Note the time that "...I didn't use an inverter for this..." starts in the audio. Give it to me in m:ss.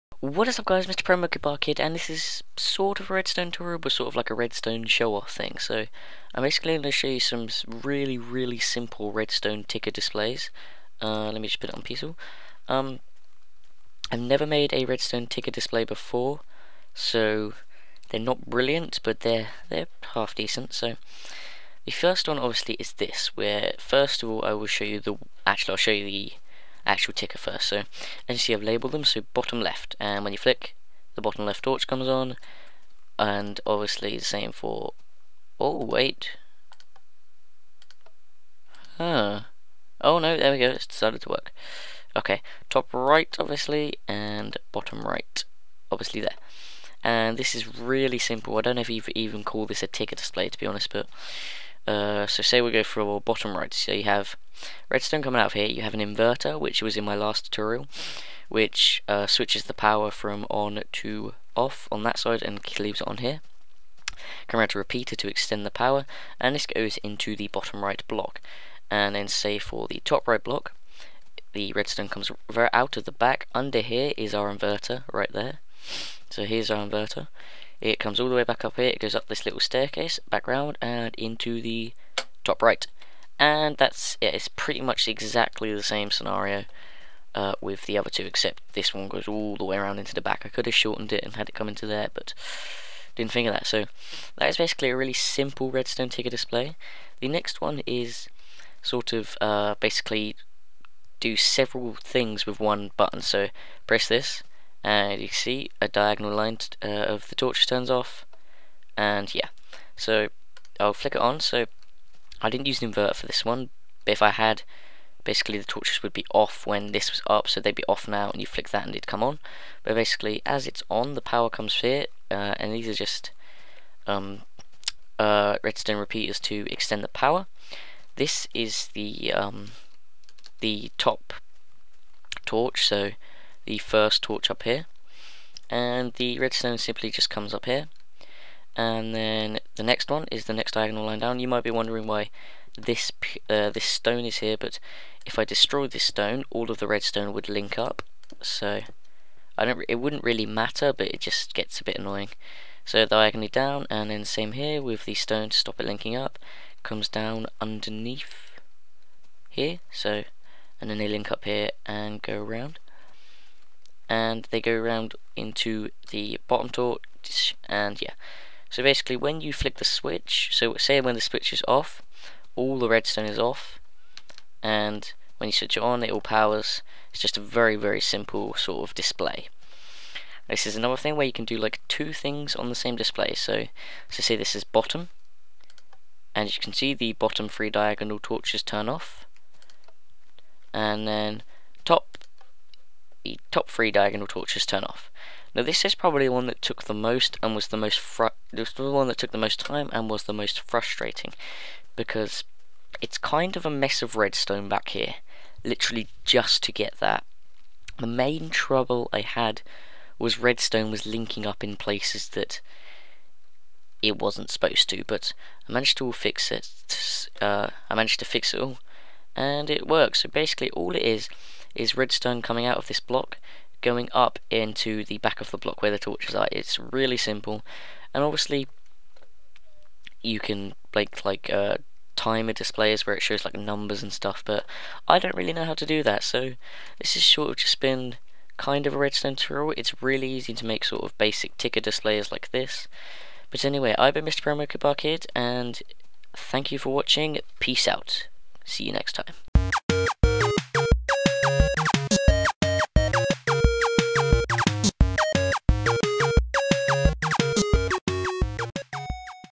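1:52.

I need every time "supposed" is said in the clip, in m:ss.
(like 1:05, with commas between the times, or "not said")
3:34.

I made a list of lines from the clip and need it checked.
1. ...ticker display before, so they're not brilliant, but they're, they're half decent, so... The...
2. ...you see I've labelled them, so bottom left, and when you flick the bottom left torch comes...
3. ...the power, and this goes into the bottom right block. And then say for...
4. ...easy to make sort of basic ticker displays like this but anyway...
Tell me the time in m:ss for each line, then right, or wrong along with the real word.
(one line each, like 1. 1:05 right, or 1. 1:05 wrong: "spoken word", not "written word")
1. 0:15 right
2. 0:28 right
3. 1:05 right
4. 4:00 right.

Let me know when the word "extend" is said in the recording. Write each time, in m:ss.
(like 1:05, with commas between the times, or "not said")
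1:05, 2:06.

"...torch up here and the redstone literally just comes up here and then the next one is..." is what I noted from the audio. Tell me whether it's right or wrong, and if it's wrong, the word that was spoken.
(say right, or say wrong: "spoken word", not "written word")
wrong: "simply", not "literally".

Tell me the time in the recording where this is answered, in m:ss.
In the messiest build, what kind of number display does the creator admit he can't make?
3:52.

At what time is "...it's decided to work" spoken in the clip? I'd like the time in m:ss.
0:40.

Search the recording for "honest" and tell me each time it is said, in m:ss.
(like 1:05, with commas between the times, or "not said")
0:50.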